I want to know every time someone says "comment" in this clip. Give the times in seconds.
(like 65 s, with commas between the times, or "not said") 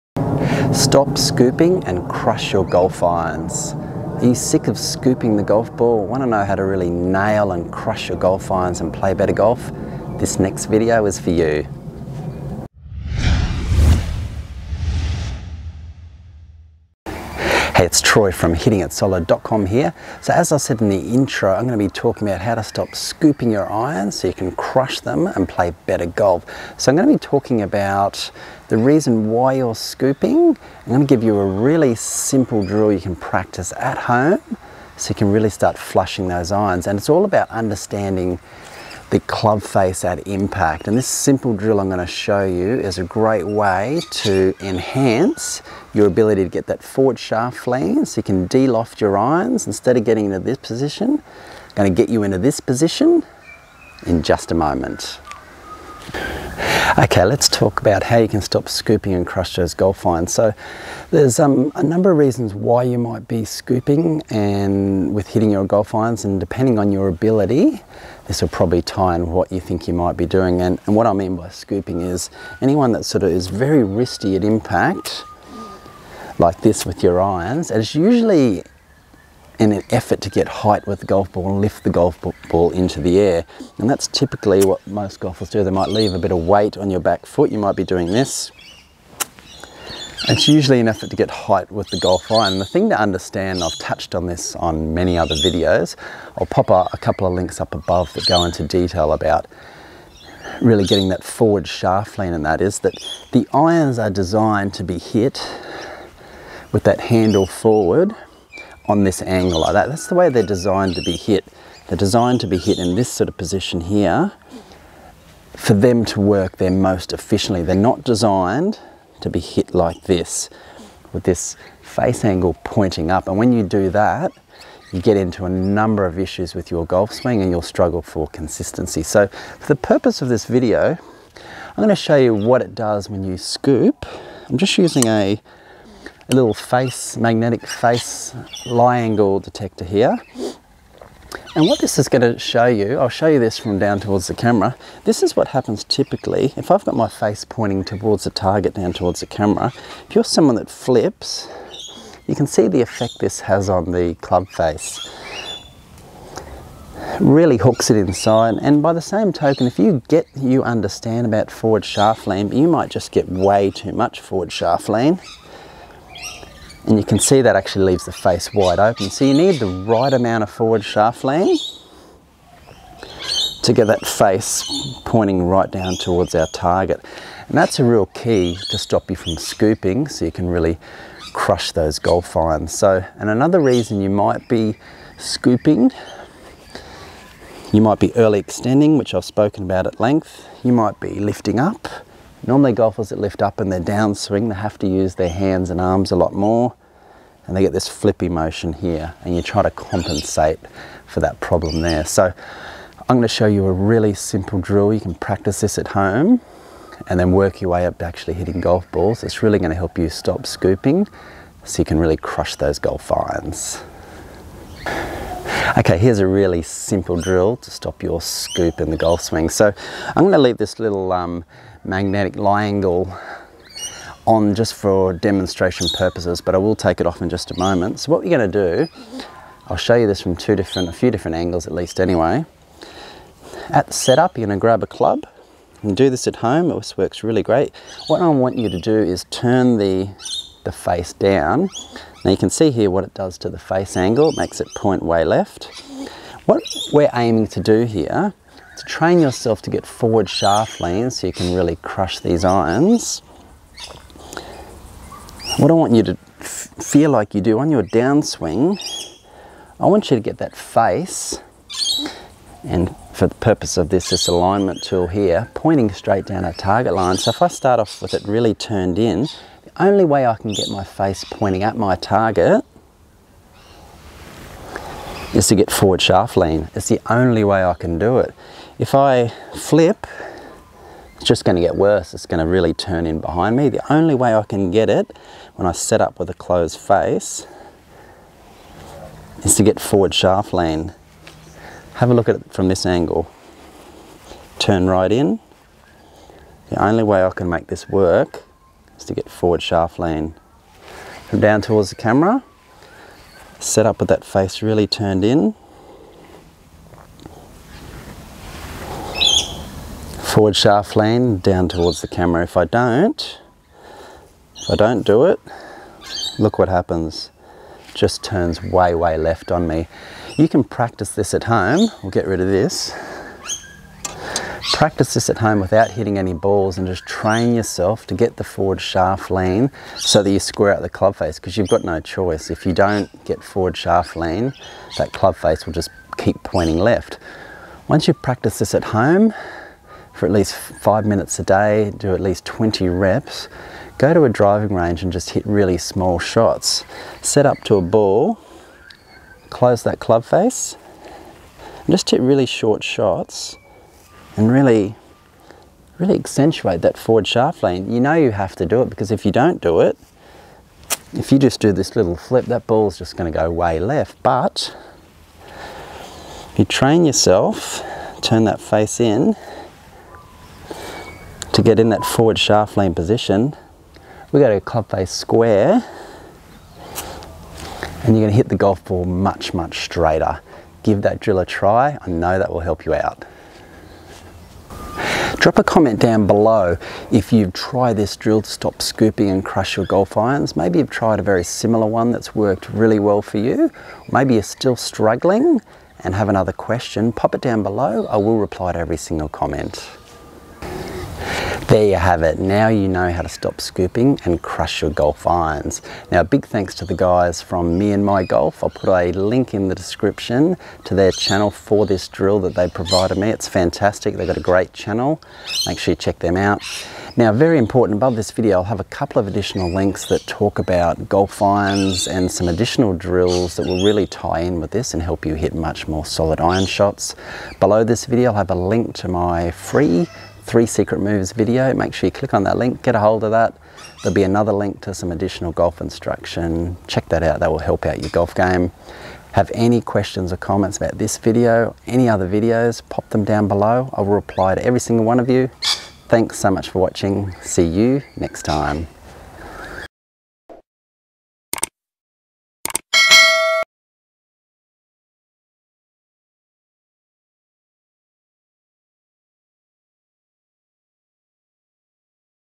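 385 s, 399 s, 440 s.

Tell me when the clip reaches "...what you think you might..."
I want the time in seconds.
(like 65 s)
69 s.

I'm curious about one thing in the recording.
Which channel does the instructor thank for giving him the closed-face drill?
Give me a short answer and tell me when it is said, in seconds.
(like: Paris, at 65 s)
Me and My Golf, at 407 s.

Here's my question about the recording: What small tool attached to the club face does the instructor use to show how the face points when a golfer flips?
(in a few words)
magnetic face lie angle detector.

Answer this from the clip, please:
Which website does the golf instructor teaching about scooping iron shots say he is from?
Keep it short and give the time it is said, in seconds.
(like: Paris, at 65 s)
HittingItSolid.com, at 18 s.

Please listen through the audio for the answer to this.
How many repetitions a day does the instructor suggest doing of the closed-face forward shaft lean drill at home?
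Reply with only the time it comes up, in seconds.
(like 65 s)
342 s.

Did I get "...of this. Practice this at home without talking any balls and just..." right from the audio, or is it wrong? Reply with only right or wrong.
wrong.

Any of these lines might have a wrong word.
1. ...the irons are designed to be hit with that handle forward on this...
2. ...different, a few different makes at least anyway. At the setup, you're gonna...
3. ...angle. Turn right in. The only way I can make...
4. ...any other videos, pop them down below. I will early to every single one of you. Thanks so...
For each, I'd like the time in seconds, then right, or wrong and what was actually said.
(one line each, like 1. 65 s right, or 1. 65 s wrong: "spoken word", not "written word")
1. 103 s right
2. 230 s wrong: "angles", not "makes"
3. 292 s right
4. 441 s wrong: "reply", not "early".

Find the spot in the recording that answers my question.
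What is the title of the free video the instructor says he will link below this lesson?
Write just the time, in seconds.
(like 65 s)
430 s.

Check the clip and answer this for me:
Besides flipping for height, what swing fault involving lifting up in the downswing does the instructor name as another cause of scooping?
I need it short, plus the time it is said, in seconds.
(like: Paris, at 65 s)
early extending, at 188 s.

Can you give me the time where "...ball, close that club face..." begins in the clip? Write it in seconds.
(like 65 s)
347 s.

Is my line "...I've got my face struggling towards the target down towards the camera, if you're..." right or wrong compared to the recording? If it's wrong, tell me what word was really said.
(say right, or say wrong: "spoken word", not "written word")
wrong: "pointing", not "struggling".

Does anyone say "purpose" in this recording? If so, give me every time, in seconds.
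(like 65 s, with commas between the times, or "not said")
129 s, 225 s, 263 s.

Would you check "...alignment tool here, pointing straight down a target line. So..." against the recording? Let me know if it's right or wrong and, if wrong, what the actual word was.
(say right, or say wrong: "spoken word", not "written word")
right.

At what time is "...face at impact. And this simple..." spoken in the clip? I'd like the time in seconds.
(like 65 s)
39 s.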